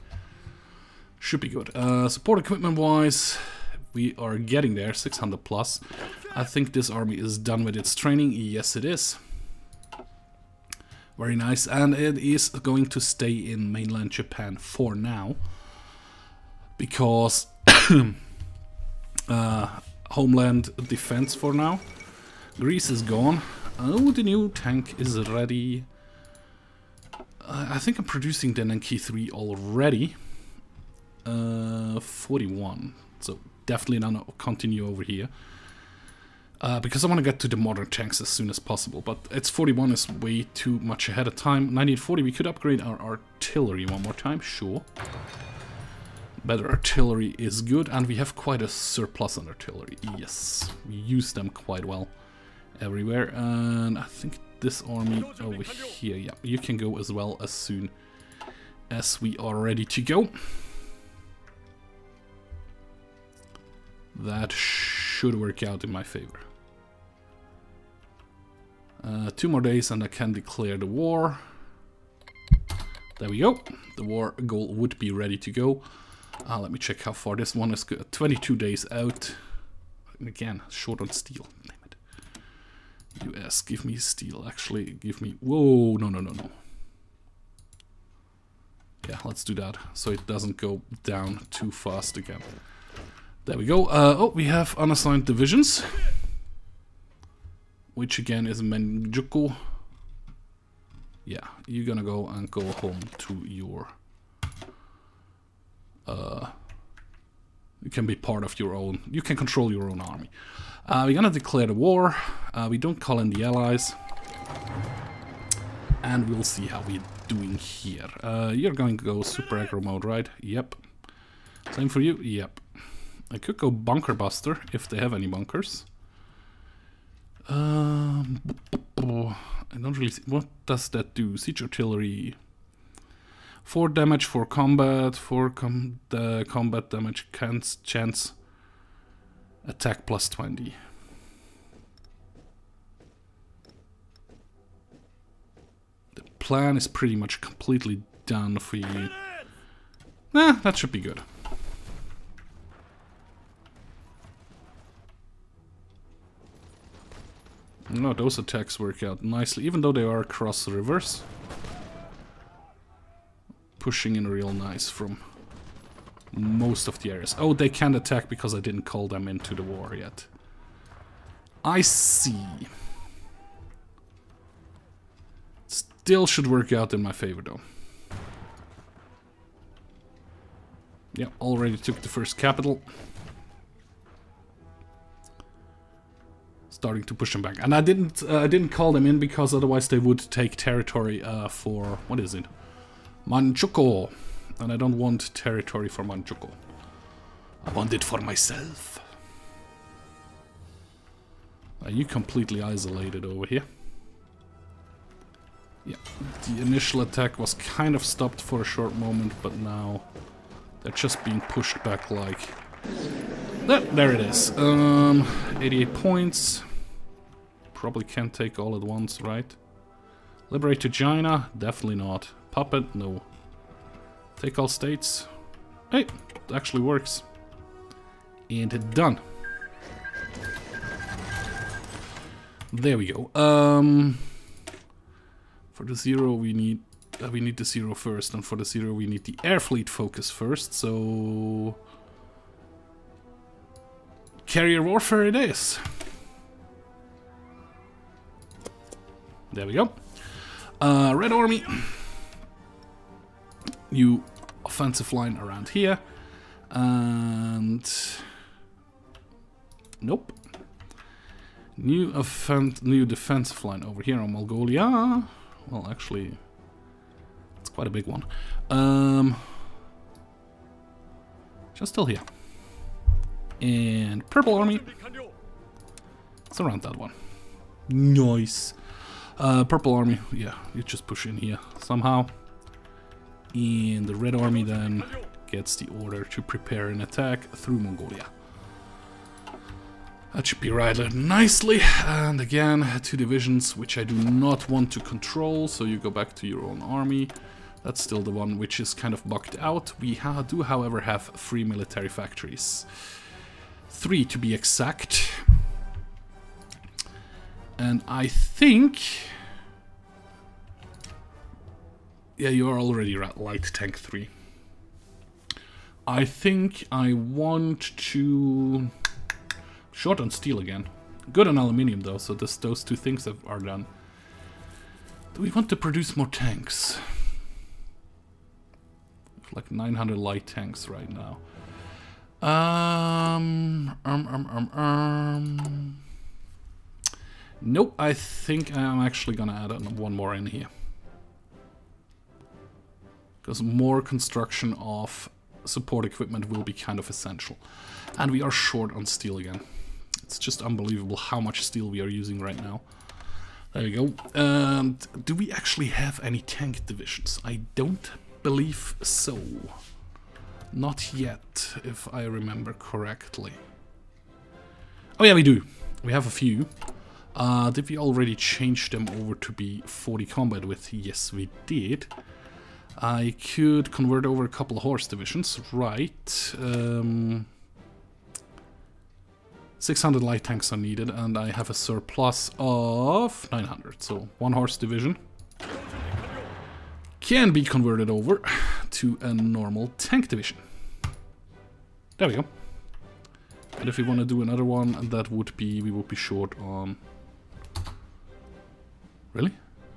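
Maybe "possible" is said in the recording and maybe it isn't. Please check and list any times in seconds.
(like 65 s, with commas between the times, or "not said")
38 s.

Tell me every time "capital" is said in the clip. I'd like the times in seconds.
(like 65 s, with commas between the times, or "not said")
182 s.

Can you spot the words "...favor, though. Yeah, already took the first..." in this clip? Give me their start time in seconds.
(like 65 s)
177 s.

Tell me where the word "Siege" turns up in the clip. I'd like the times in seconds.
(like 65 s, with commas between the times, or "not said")
131 s.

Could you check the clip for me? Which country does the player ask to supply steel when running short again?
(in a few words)
US.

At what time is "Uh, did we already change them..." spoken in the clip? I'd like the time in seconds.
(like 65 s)
367 s.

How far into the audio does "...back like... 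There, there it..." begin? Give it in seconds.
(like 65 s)
211 s.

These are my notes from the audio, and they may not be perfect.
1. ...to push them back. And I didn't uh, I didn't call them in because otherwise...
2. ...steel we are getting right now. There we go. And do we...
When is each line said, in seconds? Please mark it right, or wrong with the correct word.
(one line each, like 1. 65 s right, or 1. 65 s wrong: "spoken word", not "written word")
1. 187 s right
2. 351 s wrong: "using", not "getting".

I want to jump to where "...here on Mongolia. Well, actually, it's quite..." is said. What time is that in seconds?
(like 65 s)
264 s.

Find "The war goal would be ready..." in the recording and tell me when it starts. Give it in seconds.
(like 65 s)
73 s.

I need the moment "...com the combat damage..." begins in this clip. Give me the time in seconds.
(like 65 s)
135 s.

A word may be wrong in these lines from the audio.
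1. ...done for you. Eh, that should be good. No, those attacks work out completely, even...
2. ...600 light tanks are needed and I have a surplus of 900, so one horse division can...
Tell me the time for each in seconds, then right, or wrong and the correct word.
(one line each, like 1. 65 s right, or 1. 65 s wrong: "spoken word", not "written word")
1. 148 s wrong: "nicely", not "completely"
2. 379 s right.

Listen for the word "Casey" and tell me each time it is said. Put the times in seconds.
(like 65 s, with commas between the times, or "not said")
not said.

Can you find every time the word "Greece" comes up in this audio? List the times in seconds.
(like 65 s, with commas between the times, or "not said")
22 s.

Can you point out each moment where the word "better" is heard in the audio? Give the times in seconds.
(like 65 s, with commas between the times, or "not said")
46 s.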